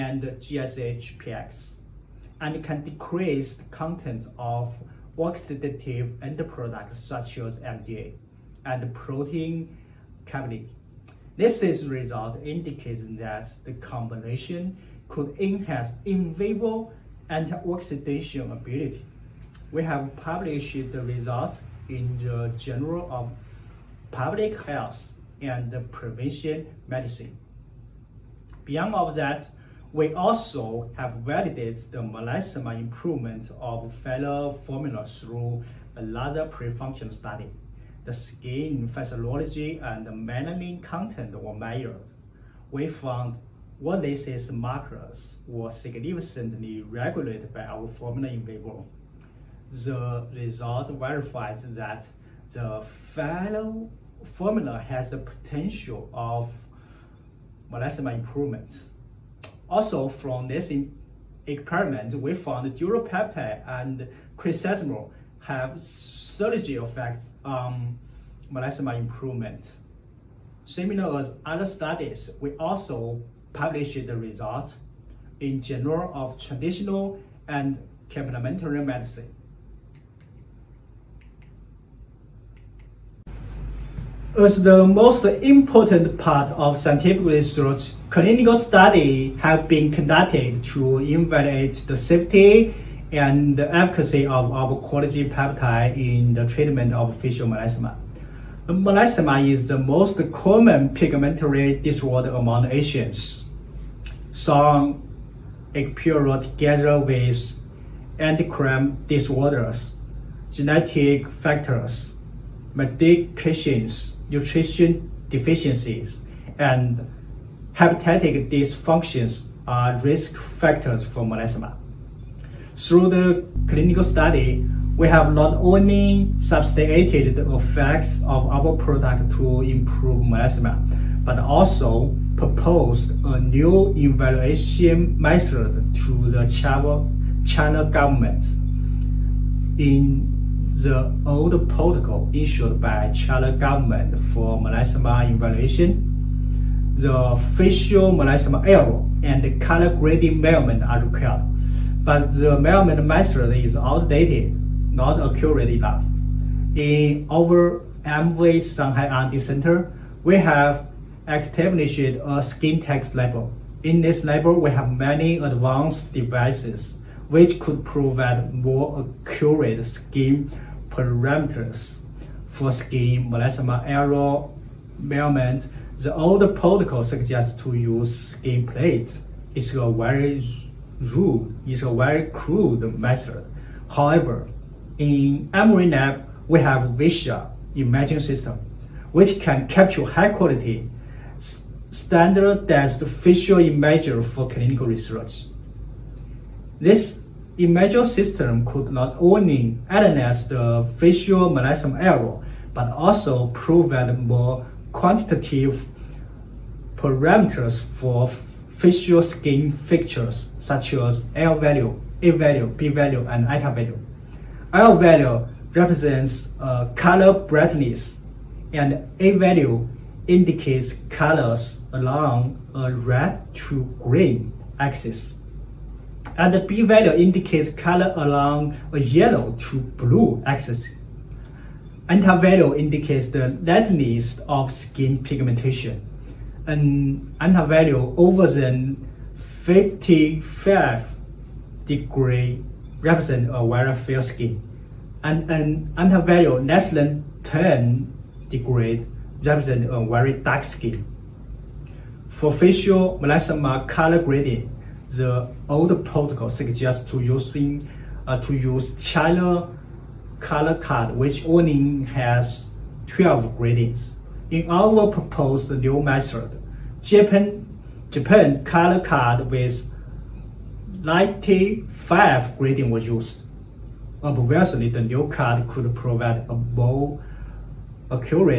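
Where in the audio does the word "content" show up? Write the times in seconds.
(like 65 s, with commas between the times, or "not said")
3 s, 40 s.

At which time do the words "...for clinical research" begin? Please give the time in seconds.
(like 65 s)
194 s.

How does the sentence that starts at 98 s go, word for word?
Melasma is the most common pigmentary disorder among Asians.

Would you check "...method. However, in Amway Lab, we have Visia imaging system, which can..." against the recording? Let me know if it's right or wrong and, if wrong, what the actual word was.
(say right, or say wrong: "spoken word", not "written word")
right.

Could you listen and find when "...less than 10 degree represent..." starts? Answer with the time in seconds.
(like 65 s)
246 s.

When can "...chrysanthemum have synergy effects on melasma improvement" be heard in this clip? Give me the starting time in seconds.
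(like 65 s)
64 s.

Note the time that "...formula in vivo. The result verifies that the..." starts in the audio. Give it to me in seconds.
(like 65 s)
47 s.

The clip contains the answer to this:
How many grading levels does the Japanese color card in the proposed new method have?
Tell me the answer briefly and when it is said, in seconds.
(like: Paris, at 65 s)
95, at 271 s.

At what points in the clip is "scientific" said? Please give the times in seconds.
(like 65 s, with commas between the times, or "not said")
86 s.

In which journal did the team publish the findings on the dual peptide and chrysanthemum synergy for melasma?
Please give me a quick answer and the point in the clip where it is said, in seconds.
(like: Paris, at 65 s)
Journal of Traditional and Complementary Medicine, at 75 s.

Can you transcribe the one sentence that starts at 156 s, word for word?
In our Amway Shanghai R&D Center, we have established a skin tax level.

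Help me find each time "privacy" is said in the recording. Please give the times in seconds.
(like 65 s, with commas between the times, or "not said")
not said.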